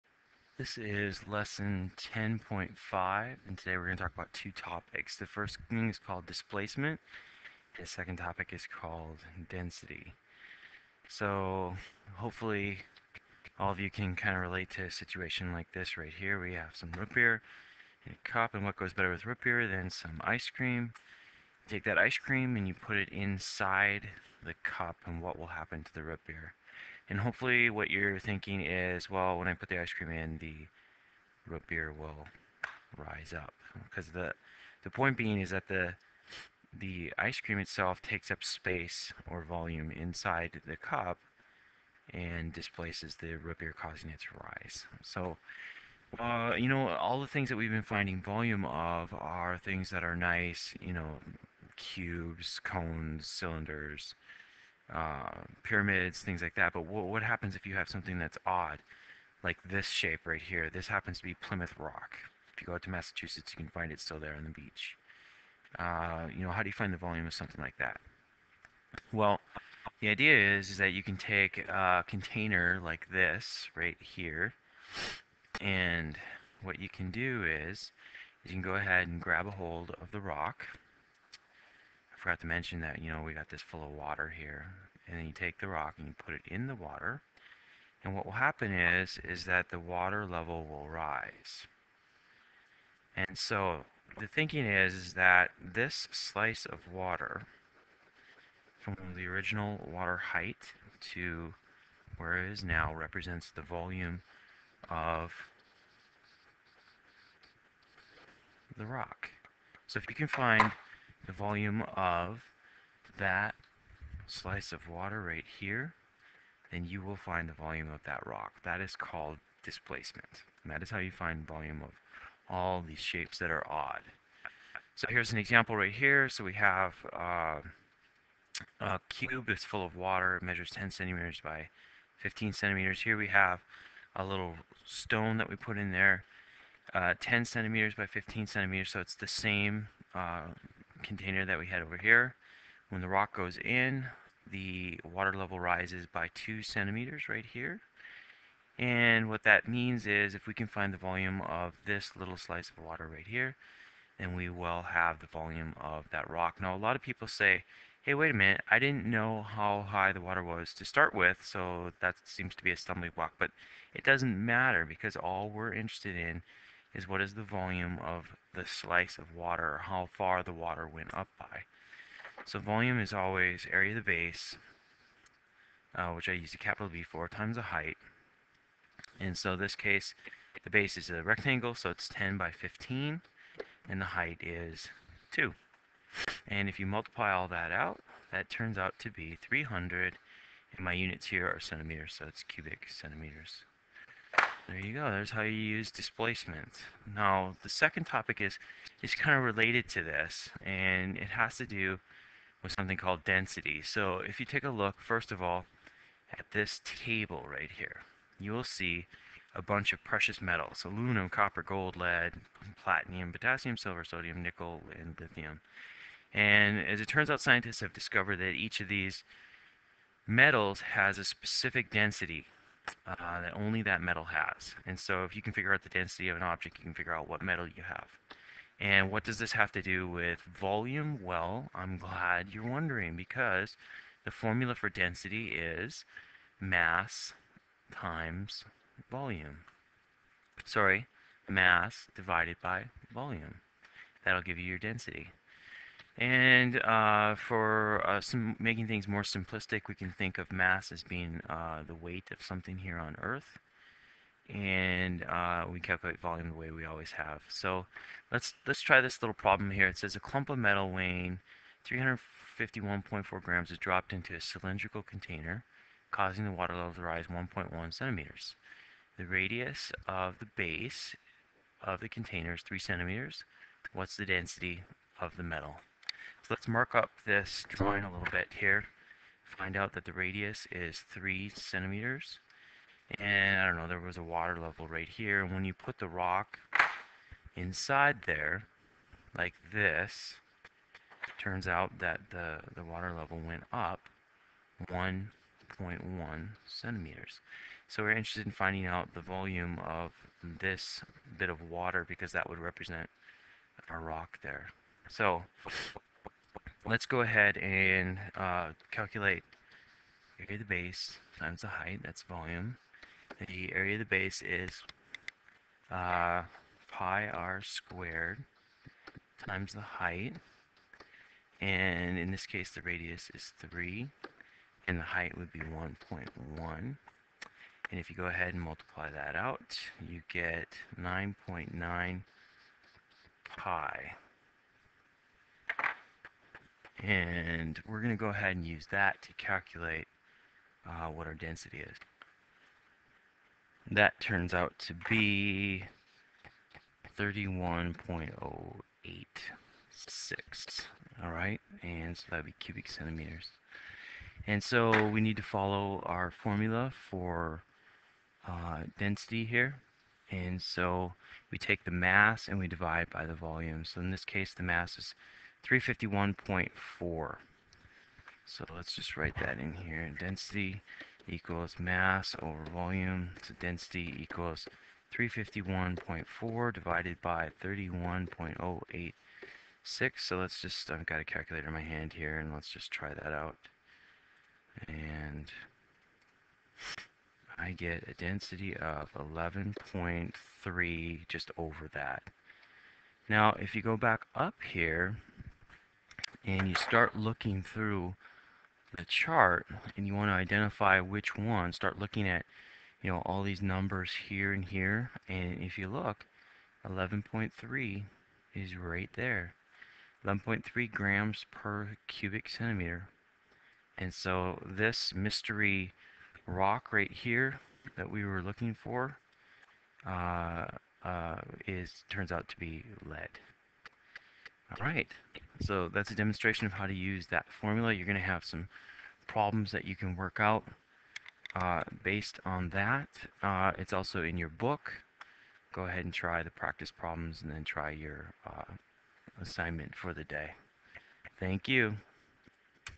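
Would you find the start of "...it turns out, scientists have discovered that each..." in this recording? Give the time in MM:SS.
03:37.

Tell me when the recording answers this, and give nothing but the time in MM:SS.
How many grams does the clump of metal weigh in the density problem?
04:21.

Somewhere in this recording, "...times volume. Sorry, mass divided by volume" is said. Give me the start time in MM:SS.
03:57.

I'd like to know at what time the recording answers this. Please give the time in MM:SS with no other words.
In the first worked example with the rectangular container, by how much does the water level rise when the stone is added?
02:26.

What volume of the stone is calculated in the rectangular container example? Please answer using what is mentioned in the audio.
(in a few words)
300 cubic centimeters.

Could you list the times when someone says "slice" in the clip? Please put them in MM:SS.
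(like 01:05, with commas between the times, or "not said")
01:36, 01:54, 02:32, 02:48.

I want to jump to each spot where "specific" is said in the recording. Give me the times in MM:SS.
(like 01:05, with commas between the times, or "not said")
03:41.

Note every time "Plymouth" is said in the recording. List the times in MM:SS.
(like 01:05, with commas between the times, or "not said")
01:01.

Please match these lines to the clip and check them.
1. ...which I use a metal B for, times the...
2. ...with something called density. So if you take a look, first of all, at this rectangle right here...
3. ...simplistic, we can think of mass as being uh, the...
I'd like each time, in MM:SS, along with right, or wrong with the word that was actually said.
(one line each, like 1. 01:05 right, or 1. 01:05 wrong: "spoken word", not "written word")
1. 02:56 wrong: "capital", not "metal"
2. 03:22 wrong: "table", not "rectangle"
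3. 04:09 right.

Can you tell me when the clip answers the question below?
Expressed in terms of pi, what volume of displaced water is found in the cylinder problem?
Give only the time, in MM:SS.
05:30.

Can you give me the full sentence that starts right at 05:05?
So let's go ahead and uh, calculate area of the base times the height, that's volume.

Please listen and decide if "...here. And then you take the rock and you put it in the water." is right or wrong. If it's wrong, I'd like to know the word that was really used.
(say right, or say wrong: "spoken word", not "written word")
right.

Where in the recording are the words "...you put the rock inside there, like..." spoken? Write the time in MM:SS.
04:45.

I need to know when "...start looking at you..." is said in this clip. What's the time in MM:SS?
06:41.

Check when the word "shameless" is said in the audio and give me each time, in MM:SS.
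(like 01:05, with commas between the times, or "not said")
not said.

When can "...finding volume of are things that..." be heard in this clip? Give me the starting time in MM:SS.
00:47.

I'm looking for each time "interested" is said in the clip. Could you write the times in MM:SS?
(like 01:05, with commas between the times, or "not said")
02:45, 04:58.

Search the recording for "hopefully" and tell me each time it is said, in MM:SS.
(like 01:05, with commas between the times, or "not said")
00:12, 00:27.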